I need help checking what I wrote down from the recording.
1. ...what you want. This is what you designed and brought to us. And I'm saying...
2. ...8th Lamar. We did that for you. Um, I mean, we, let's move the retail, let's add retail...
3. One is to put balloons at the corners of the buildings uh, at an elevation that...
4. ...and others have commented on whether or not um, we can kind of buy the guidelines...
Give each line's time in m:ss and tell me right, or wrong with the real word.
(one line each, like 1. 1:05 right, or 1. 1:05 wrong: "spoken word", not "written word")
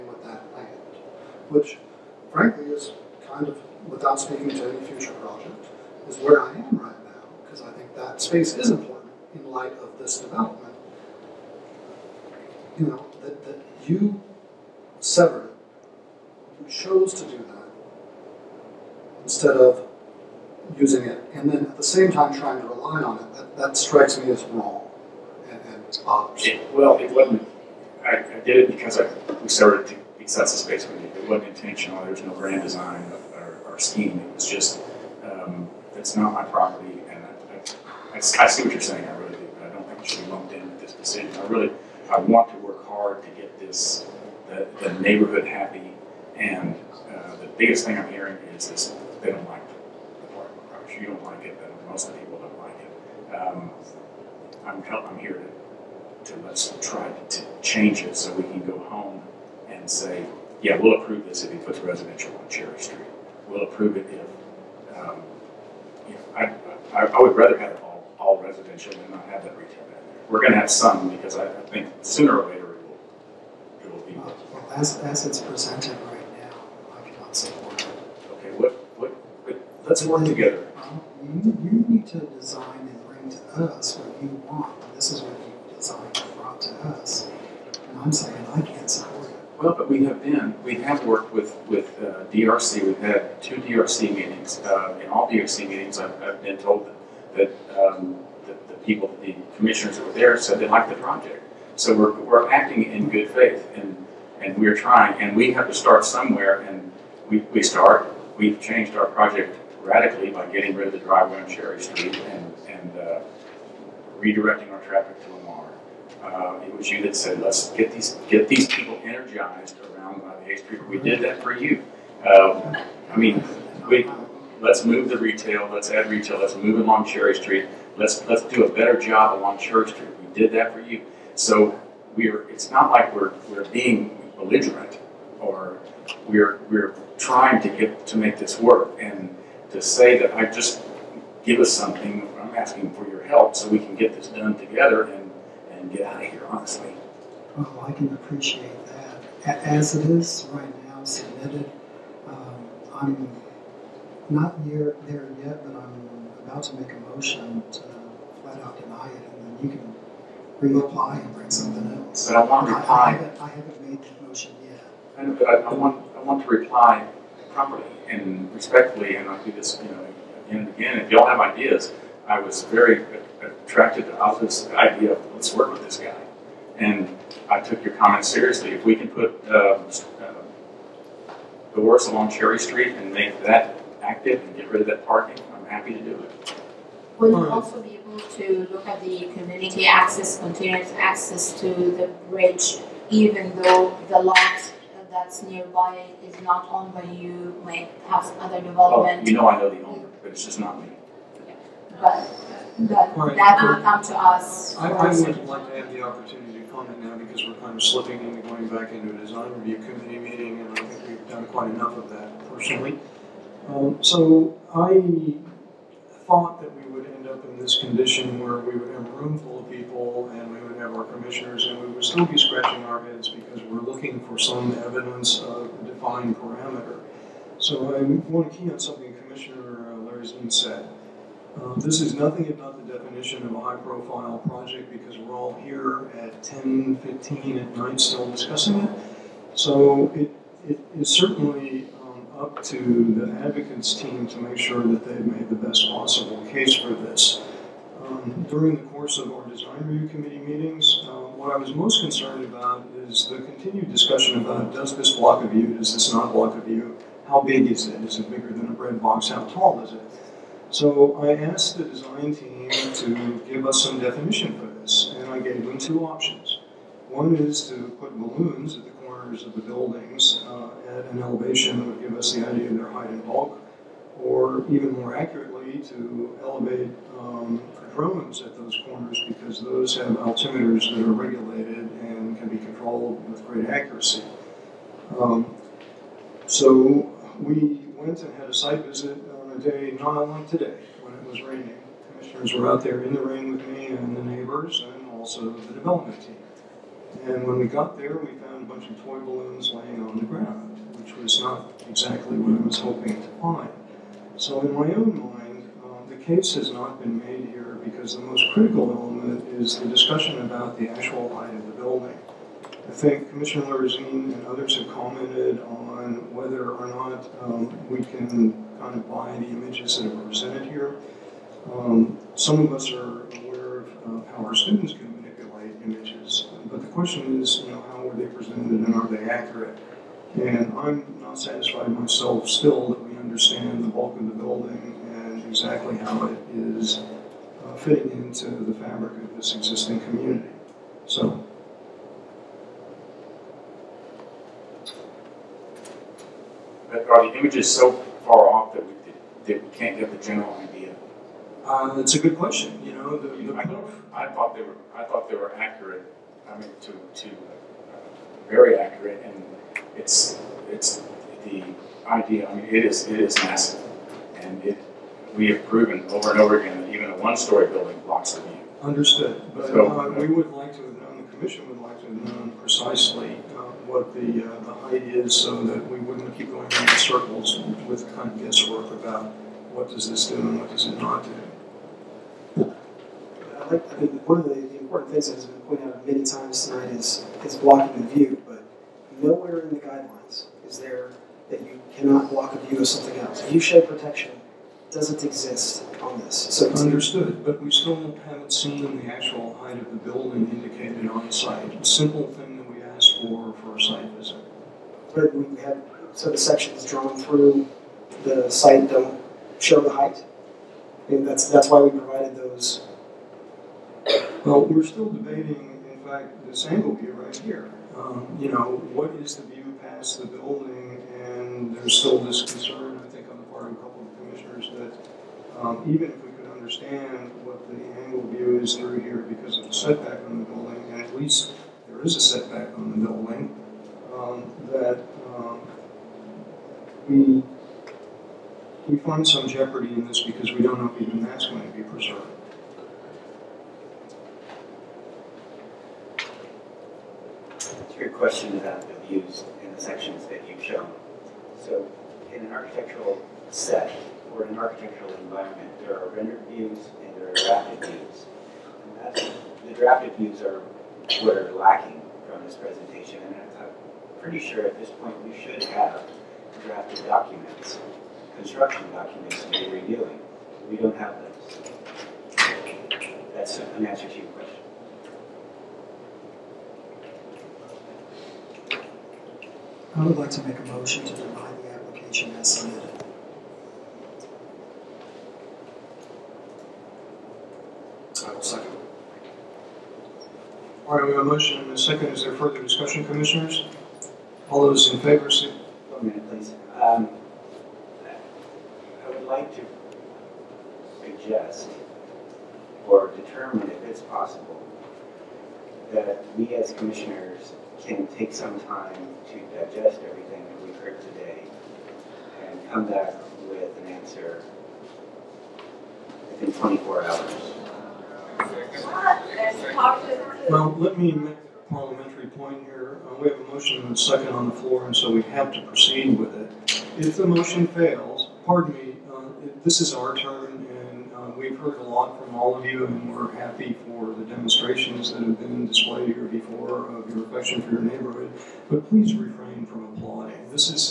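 1. 1:23 right
2. 2:00 wrong: "Street", not "Lamar"
3. 4:27 right
4. 5:14 wrong: "images", not "guidelines".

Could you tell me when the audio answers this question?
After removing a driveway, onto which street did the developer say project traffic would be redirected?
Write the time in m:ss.
1:55.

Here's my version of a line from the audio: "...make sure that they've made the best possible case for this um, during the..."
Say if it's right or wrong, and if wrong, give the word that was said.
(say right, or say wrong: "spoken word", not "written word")
right.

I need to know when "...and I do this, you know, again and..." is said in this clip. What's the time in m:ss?
2:49.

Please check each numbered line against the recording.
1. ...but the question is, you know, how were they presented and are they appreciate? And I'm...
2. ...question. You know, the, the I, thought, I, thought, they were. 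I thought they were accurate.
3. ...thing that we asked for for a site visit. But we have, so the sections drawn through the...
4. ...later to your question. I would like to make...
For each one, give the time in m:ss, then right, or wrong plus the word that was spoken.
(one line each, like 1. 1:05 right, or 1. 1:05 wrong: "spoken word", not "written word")
1. 5:26 wrong: "accurate", not "appreciate"
2. 5:52 right
3. 6:42 right
4. 7:53 wrong: "answer", not "later".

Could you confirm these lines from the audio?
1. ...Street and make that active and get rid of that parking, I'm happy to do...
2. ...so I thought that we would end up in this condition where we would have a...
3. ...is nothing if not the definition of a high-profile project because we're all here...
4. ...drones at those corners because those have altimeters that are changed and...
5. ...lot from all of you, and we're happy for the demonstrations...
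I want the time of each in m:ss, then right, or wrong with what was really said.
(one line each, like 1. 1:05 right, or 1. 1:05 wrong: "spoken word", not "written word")
1. 3:02 right
2. 3:34 right
3. 3:52 right
4. 4:37 wrong: "regulated", not "changed"
5. 8:51 right.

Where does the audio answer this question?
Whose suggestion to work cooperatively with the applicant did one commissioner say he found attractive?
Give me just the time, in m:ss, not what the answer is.
2:54.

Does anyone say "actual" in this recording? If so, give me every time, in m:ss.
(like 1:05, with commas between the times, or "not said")
5:10, 6:39.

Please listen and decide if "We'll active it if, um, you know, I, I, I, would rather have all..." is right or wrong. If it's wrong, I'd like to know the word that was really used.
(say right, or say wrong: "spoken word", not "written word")
wrong: "approve", not "active".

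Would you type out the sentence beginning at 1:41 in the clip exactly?
So we're, we're acting in good faith, and, and we're trying.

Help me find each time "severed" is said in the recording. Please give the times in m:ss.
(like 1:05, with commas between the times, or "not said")
0:15.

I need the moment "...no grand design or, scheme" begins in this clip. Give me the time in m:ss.
0:32.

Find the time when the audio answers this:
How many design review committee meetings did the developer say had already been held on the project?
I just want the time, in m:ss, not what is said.
1:33.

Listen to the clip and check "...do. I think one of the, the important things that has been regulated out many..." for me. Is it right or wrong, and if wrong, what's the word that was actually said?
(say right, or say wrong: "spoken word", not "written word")
wrong: "pointed", not "regulated".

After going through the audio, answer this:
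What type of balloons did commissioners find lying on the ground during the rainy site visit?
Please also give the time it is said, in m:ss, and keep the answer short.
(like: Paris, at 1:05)
toy balloons, at 4:59.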